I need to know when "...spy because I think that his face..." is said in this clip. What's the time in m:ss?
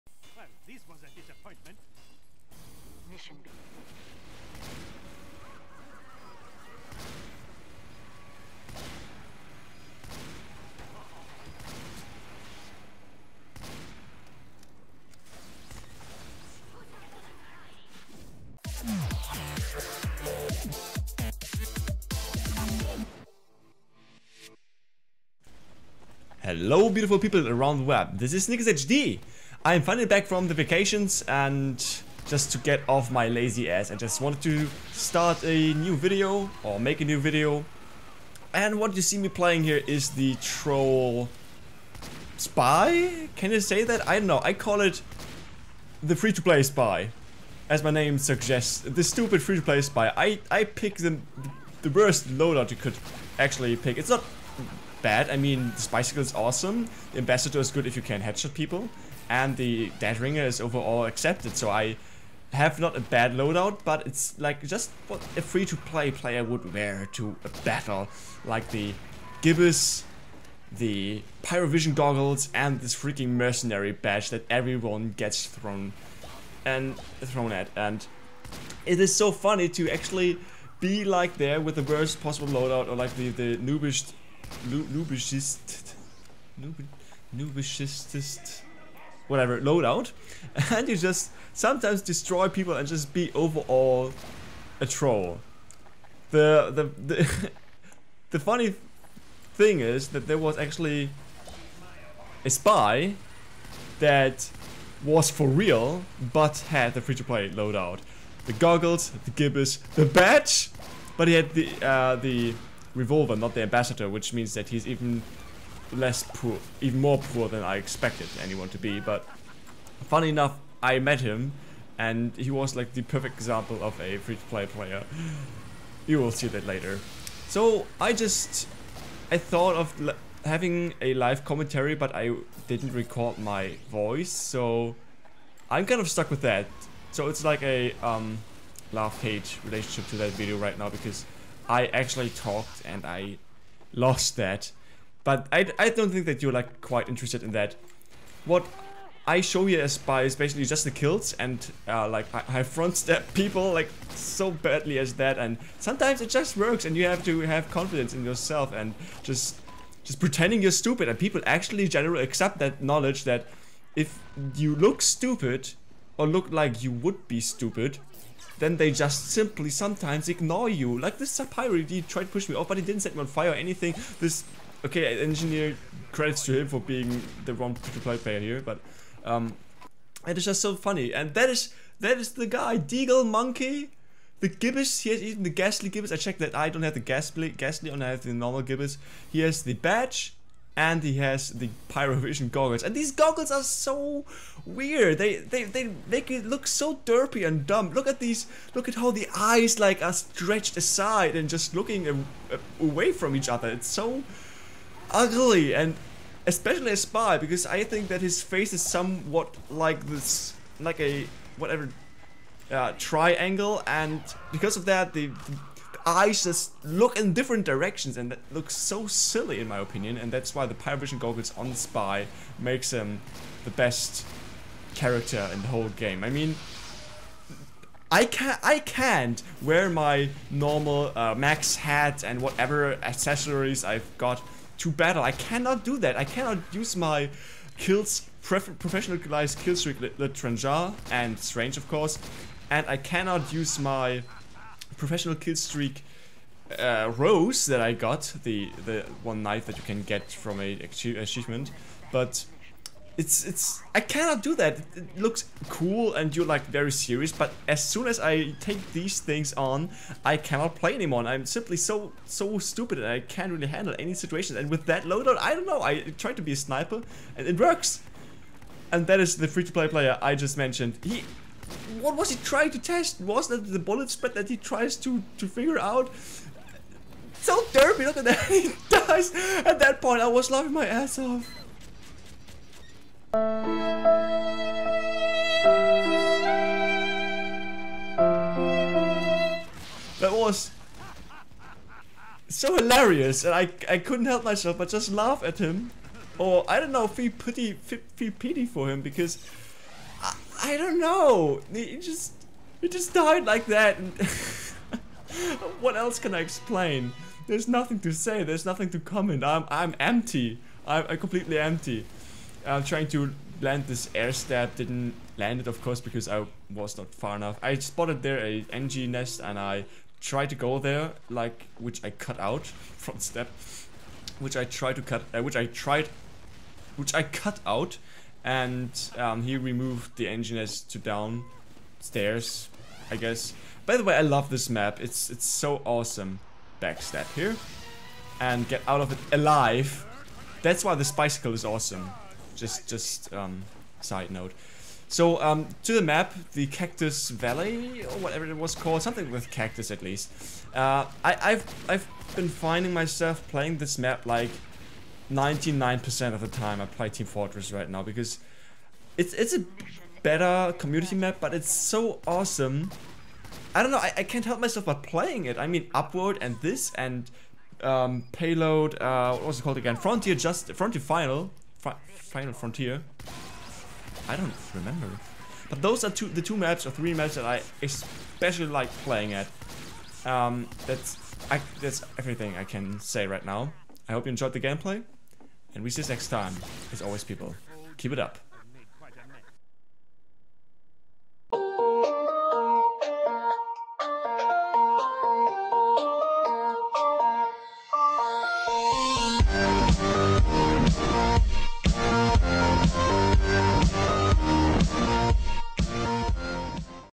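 3:26.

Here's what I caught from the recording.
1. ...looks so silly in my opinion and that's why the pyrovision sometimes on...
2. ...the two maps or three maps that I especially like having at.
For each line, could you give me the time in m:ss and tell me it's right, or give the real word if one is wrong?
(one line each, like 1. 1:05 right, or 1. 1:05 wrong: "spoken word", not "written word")
1. 3:38 wrong: "goggles", not "sometimes"
2. 6:16 wrong: "playing", not "having".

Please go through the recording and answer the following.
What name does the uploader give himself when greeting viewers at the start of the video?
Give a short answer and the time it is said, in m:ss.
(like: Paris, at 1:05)
SnikkasHD, at 0:28.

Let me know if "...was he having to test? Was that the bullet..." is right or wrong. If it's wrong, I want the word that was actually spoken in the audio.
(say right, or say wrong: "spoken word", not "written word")
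wrong: "trying", not "having".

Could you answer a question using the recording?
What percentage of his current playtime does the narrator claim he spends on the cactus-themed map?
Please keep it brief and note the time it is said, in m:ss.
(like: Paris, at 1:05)
99%, at 5:55.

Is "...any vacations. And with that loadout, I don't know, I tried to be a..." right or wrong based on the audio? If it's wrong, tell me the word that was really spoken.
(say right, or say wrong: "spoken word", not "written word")
wrong: "situations", not "vacations".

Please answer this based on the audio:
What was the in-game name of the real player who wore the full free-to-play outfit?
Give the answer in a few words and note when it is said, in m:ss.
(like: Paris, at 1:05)
Deagle Monkey, at 3:02.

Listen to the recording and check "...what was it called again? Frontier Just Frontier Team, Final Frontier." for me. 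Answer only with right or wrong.
wrong.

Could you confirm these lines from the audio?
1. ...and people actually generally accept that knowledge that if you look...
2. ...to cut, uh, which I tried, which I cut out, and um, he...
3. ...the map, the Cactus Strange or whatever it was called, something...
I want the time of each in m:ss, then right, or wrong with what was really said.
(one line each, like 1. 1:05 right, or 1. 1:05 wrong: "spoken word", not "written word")
1. 2:41 right
2. 5:24 right
3. 5:45 wrong: "Valley", not "Strange".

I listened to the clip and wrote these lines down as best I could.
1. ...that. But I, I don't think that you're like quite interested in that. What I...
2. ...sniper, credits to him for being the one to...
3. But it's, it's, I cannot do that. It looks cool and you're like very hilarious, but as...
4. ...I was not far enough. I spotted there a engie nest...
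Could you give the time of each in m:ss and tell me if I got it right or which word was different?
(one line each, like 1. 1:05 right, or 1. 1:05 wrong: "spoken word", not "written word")
1. 2:24 right
2. 2:55 wrong: "engineer", not "sniper"
3. 4:12 wrong: "serious", not "hilarious"
4. 5:16 right.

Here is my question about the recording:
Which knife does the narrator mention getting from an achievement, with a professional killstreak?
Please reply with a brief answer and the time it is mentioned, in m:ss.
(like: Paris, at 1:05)
Rose, at 4:07.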